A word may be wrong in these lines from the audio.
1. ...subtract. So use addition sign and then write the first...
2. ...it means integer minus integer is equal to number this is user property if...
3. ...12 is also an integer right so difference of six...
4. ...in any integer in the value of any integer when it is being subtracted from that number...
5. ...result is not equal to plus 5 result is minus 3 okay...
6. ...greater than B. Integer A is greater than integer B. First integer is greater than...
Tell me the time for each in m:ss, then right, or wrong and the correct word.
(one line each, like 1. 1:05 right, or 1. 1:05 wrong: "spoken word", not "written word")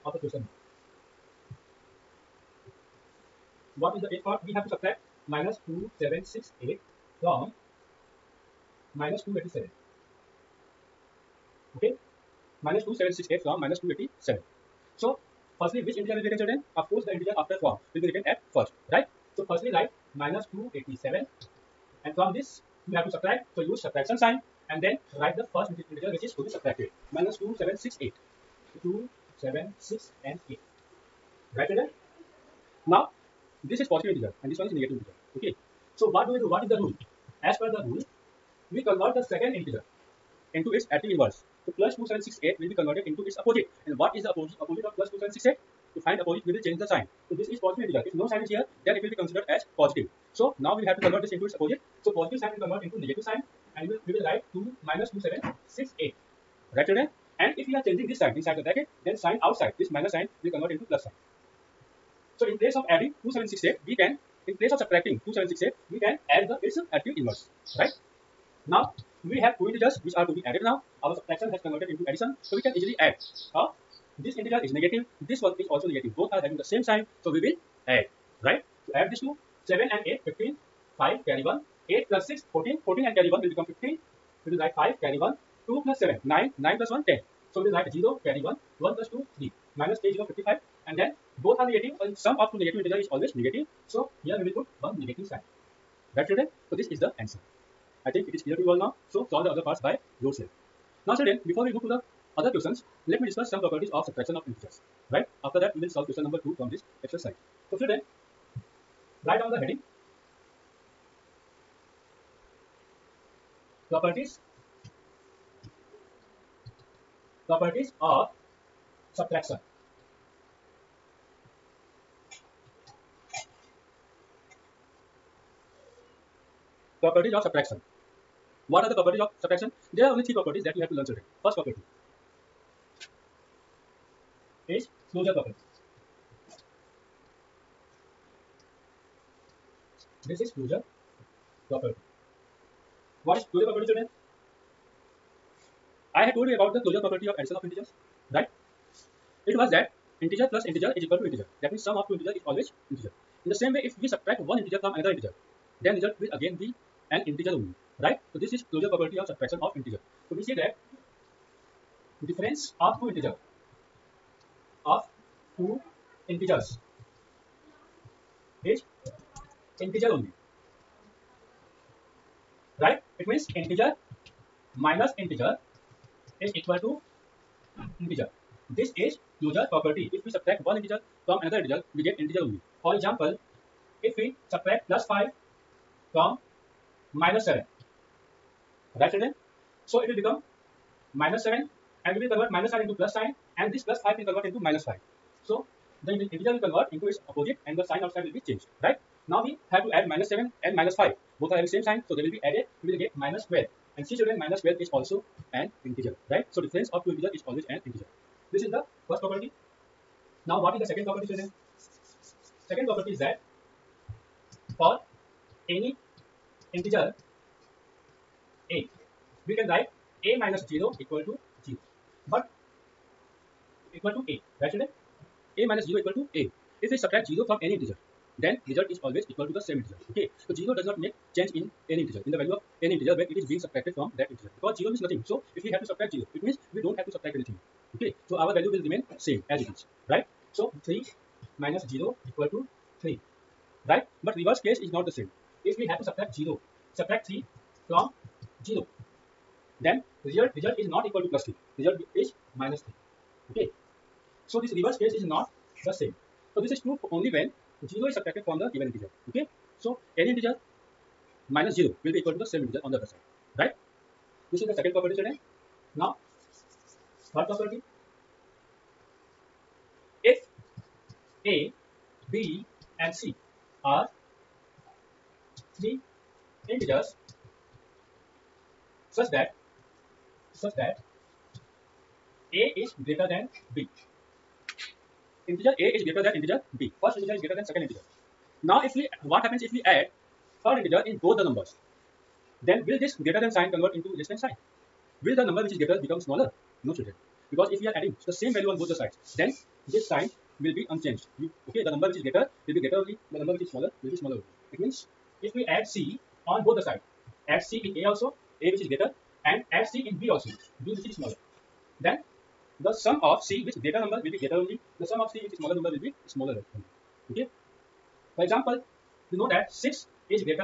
1. 0:23 wrong: "subtraction", not "addition"
2. 2:53 wrong: "integer", not "number"
3. 3:24 wrong: "two", not "six"
4. 3:51 wrong: "integer", not "number"
5. 4:10 wrong: "3", not "5"
6. 4:43 right.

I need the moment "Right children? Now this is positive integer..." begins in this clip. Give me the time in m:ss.
0:31.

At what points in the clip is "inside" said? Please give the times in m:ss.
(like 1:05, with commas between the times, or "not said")
0:58.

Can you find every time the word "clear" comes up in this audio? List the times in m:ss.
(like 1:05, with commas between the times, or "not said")
1:38.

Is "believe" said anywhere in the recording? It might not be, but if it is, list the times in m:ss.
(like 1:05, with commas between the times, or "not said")
not said.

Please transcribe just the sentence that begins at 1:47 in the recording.
So children, write down the heading.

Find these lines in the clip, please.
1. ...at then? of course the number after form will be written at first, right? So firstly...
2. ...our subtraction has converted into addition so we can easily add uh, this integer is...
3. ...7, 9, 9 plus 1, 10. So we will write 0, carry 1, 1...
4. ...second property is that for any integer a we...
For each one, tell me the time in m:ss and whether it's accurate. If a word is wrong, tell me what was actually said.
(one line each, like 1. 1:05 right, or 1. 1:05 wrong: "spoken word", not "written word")
1. 0:16 wrong: "integer", not "number"
2. 1:11 right
3. 1:25 right
4. 3:32 right.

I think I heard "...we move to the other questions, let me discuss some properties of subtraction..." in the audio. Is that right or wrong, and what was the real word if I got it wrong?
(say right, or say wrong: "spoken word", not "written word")
right.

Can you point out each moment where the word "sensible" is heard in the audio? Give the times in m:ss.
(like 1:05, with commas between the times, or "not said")
not said.